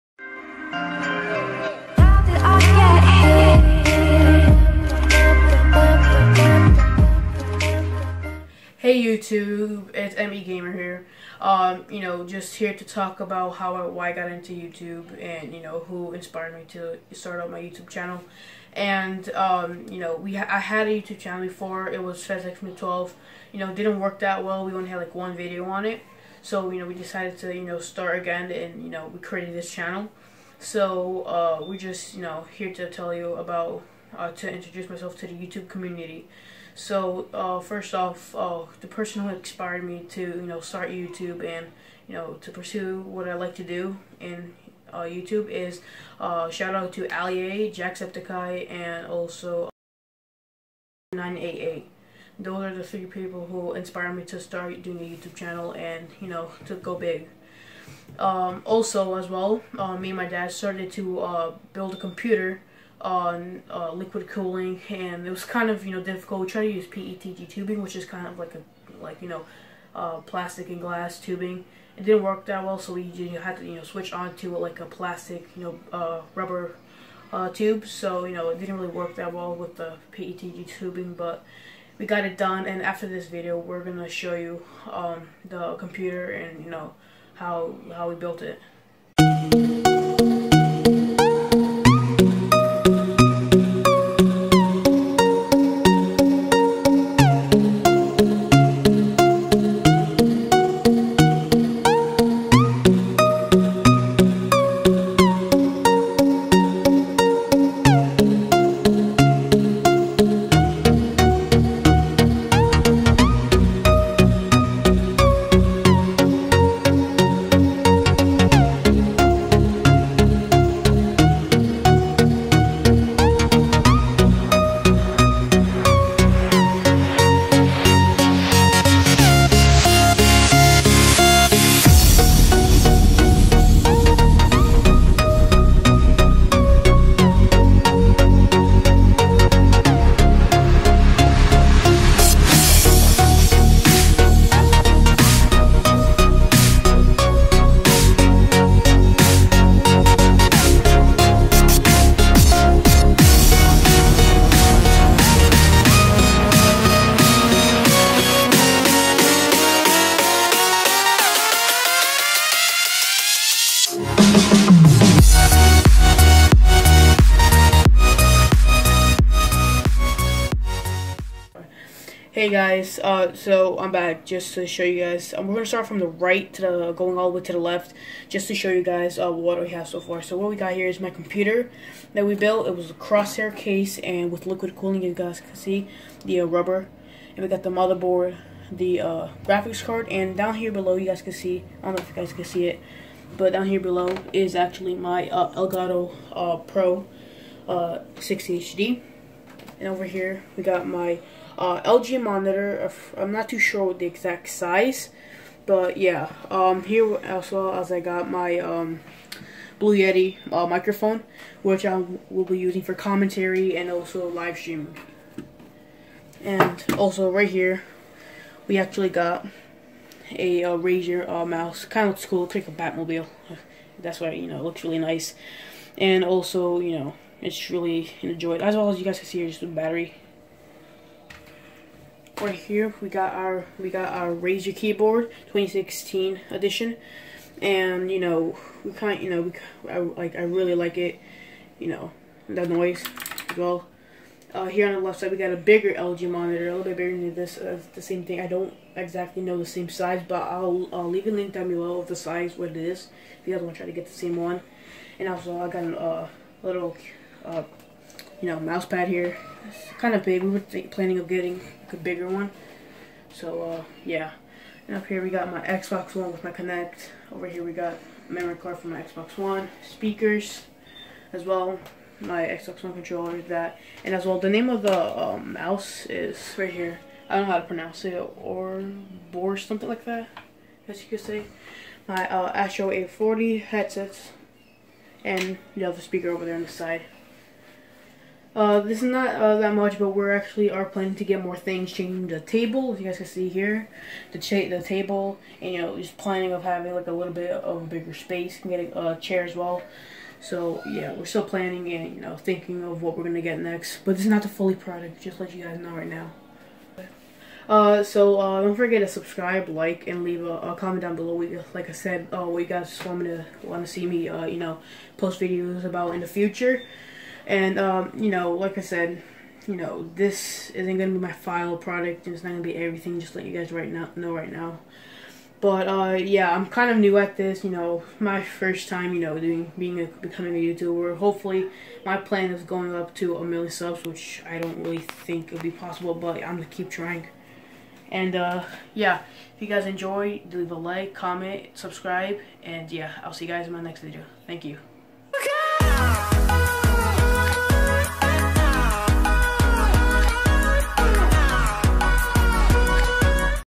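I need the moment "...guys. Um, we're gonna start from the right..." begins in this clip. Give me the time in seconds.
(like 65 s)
175 s.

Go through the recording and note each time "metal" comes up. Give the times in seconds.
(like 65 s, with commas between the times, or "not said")
not said.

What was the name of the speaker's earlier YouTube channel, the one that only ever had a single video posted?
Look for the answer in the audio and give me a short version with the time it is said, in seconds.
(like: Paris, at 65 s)
FezX 12, at 22 s.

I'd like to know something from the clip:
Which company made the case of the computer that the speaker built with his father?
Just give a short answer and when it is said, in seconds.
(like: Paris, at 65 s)
Corsair, at 182 s.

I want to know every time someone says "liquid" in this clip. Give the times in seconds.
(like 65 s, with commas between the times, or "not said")
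63 s, 184 s.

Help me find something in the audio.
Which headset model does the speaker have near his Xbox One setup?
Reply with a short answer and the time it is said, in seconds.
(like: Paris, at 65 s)
Astro A40, at 282 s.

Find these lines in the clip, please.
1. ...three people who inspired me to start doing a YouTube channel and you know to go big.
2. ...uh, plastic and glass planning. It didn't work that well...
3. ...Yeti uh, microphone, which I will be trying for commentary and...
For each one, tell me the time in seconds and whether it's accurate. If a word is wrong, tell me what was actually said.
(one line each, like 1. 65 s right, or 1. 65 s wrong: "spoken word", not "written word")
1. 52 s right
2. 69 s wrong: "tubing", not "planning"
3. 209 s wrong: "using", not "trying".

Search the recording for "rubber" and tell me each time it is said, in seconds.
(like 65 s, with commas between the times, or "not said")
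76 s, 186 s.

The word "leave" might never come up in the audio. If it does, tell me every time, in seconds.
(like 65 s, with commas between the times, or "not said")
251 s, 310 s, 340 s.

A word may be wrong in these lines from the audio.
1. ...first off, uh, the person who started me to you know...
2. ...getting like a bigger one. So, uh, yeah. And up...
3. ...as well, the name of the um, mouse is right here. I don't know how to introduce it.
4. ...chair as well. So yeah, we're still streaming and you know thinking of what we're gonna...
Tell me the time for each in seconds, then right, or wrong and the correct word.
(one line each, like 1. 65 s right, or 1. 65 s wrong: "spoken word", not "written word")
1. 37 s wrong: "inspired", not "started"
2. 261 s right
3. 274 s wrong: "pronounce", not "introduce"
4. 299 s wrong: "planning", not "streaming".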